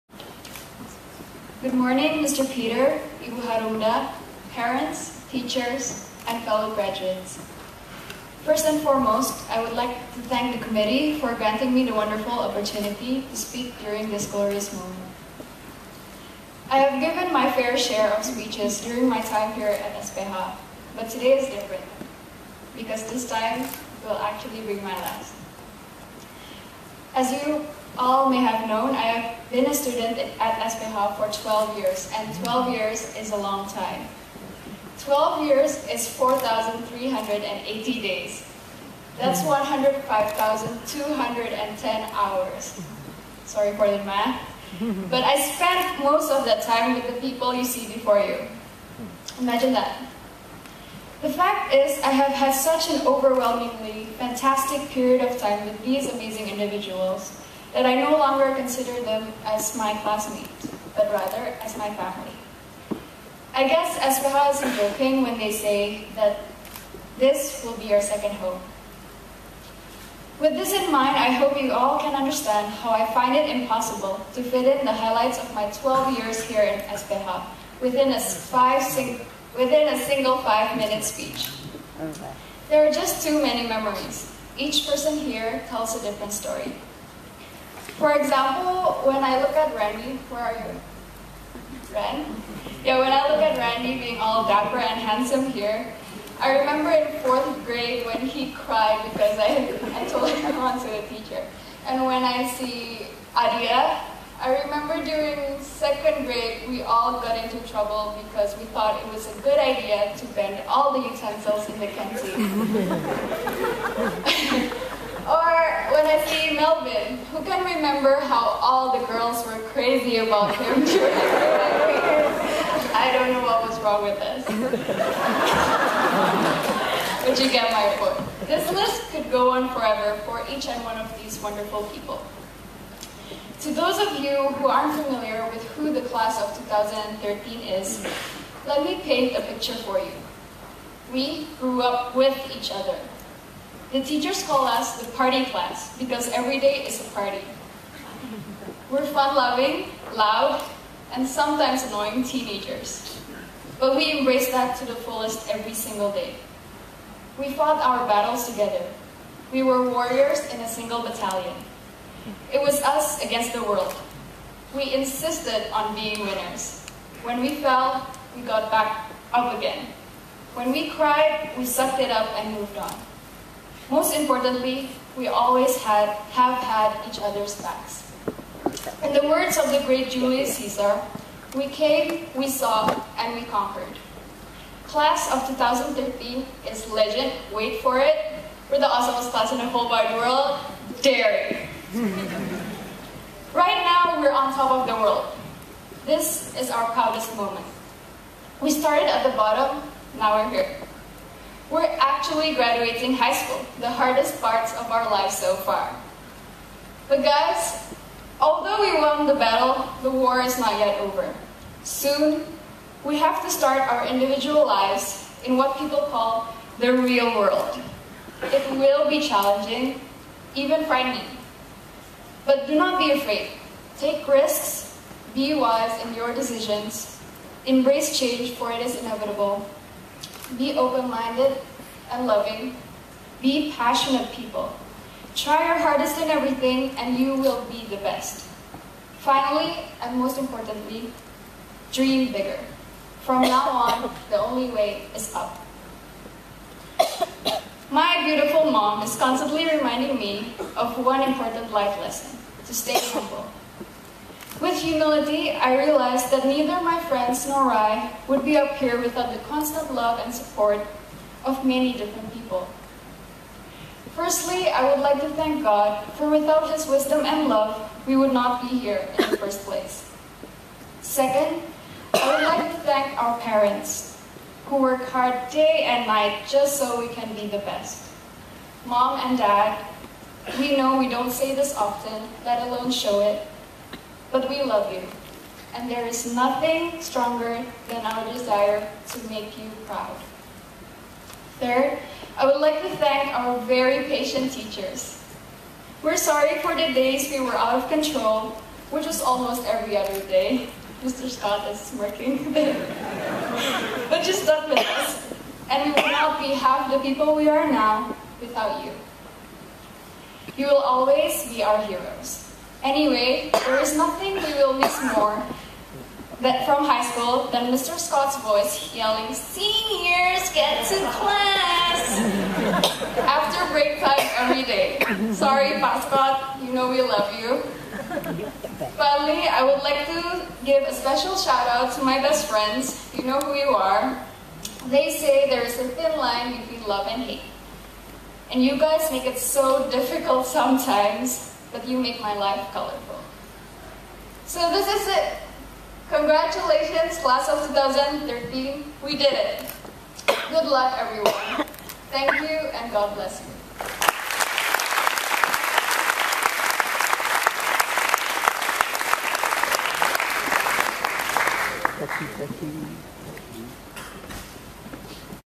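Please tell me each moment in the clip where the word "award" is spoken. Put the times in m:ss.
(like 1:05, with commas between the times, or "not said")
not said.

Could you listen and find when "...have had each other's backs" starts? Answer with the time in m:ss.
2:56.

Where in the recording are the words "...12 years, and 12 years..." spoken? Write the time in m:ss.
0:31.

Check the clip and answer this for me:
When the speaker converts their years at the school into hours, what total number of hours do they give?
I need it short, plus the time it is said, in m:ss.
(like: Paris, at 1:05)
105,210, at 0:39.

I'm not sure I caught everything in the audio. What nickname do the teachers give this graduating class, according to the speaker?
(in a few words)
the party class.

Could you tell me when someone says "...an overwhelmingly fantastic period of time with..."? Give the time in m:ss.
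0:52.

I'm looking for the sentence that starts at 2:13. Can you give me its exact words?
To those of you who aren't familiar with who the class of 2013 is, let me paint a picture for you.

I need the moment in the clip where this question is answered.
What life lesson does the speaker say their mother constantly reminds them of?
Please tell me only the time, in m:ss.
4:12.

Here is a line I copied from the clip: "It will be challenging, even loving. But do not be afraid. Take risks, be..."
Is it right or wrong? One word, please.
wrong.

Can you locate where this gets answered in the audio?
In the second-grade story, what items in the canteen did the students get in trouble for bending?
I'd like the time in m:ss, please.
1:51.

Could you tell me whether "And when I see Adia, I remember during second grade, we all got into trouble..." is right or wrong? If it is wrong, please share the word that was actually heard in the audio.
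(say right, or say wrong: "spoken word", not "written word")
right.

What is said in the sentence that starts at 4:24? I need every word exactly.
Firstly, I would like to thank God, for without His wisdom and love, we would not be here in the first place.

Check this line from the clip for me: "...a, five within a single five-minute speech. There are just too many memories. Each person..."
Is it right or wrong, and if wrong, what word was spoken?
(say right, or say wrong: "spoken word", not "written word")
right.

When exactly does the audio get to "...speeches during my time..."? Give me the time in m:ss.
0:18.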